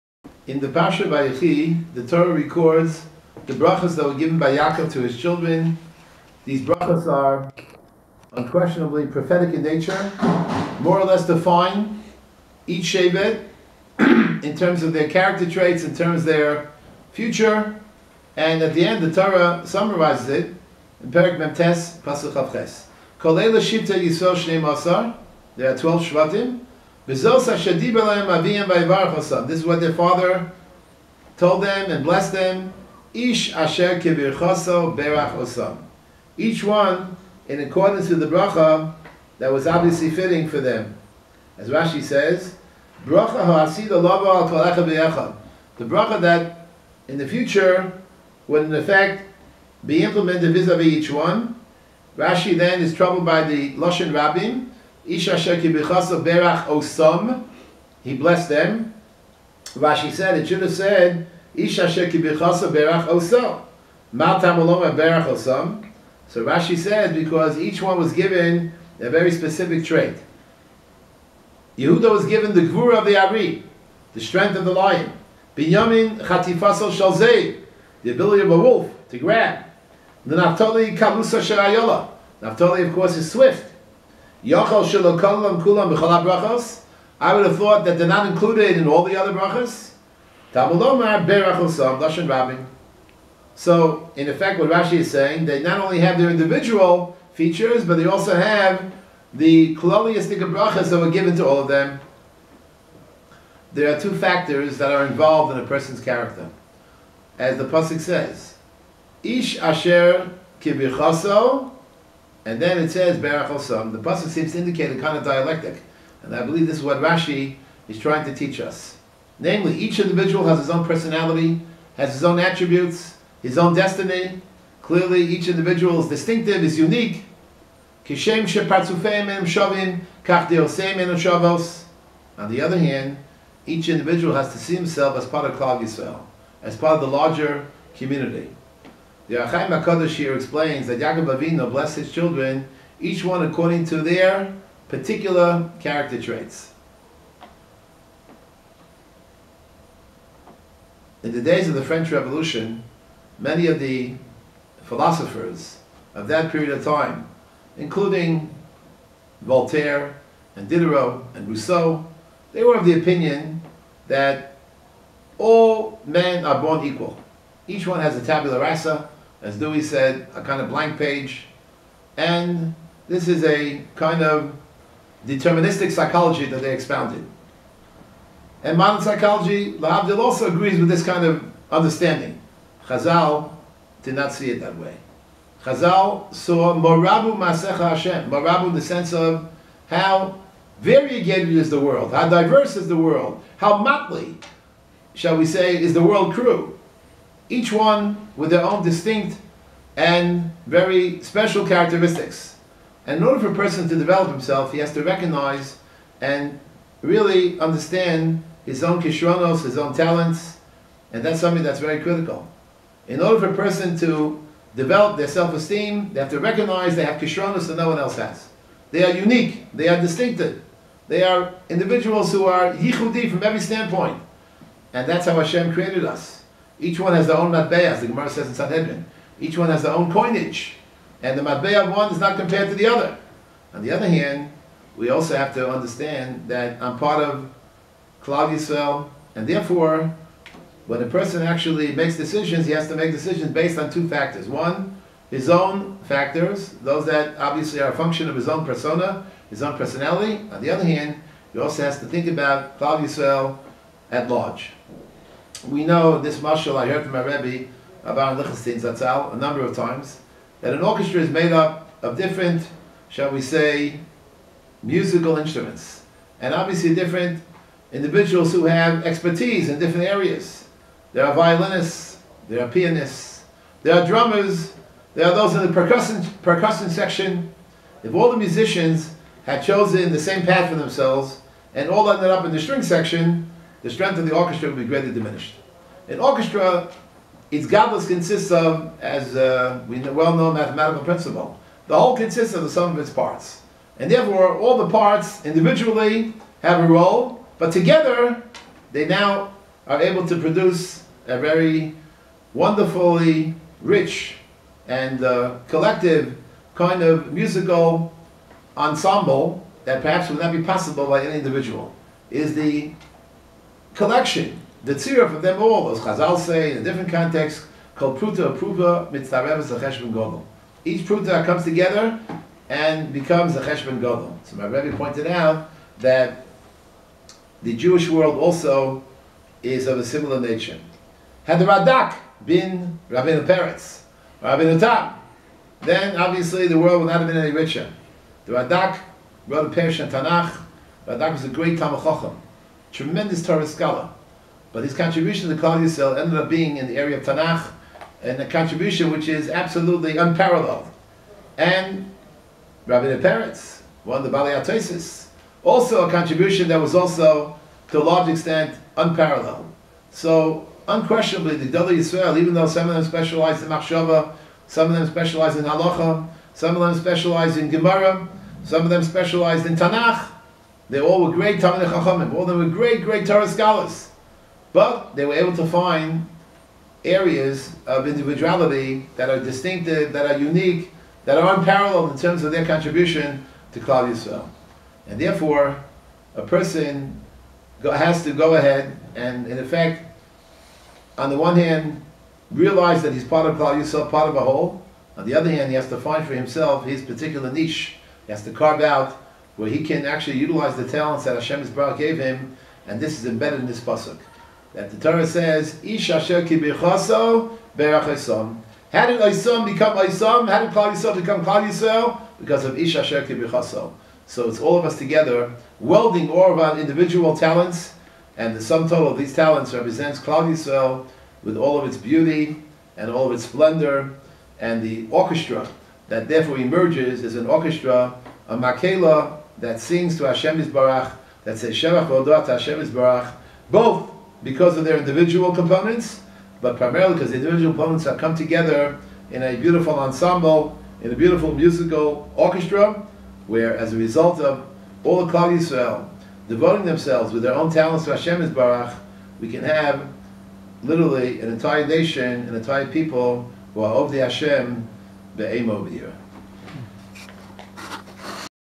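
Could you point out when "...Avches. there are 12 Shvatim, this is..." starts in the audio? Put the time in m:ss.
0:22.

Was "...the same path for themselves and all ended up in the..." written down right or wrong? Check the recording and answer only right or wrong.
right.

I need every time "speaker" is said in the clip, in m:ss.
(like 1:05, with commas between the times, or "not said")
not said.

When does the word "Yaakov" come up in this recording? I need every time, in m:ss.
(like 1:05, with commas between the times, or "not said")
0:04, 2:20.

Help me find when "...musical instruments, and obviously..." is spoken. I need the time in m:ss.
4:24.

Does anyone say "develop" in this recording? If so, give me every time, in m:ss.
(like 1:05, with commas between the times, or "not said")
3:23, 3:34.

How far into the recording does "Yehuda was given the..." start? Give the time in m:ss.
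1:11.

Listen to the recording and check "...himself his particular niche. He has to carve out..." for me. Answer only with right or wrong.
right.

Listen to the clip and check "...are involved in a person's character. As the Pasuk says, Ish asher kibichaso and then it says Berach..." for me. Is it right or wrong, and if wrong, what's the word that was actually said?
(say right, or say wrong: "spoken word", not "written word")
right.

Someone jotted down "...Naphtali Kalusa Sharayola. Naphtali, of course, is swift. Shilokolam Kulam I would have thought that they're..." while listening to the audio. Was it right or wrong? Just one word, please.
right.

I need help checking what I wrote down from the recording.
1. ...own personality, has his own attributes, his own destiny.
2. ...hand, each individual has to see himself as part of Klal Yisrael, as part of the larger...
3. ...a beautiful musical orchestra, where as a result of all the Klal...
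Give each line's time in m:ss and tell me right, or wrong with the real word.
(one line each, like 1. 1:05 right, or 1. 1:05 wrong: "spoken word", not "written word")
1. 2:00 right
2. 2:12 right
3. 7:21 right.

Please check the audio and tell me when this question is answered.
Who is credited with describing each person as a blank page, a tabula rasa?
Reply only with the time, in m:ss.
2:49.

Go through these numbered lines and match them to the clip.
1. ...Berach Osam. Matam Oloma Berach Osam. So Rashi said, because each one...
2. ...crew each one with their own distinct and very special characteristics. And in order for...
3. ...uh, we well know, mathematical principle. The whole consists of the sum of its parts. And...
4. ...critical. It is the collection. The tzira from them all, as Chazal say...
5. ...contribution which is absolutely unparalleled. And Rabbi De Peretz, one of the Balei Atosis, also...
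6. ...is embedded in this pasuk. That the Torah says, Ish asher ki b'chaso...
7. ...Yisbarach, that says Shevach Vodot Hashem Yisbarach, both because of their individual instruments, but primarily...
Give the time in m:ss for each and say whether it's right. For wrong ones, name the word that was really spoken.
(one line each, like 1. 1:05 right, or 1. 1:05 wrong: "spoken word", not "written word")
1. 1:02 right
2. 3:16 right
3. 4:49 right
4. 5:11 wrong: "individual", not "critical"
5. 5:48 right
6. 6:43 right
7. 7:10 wrong: "components", not "instruments".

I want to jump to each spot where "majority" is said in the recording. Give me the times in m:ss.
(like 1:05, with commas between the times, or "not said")
not said.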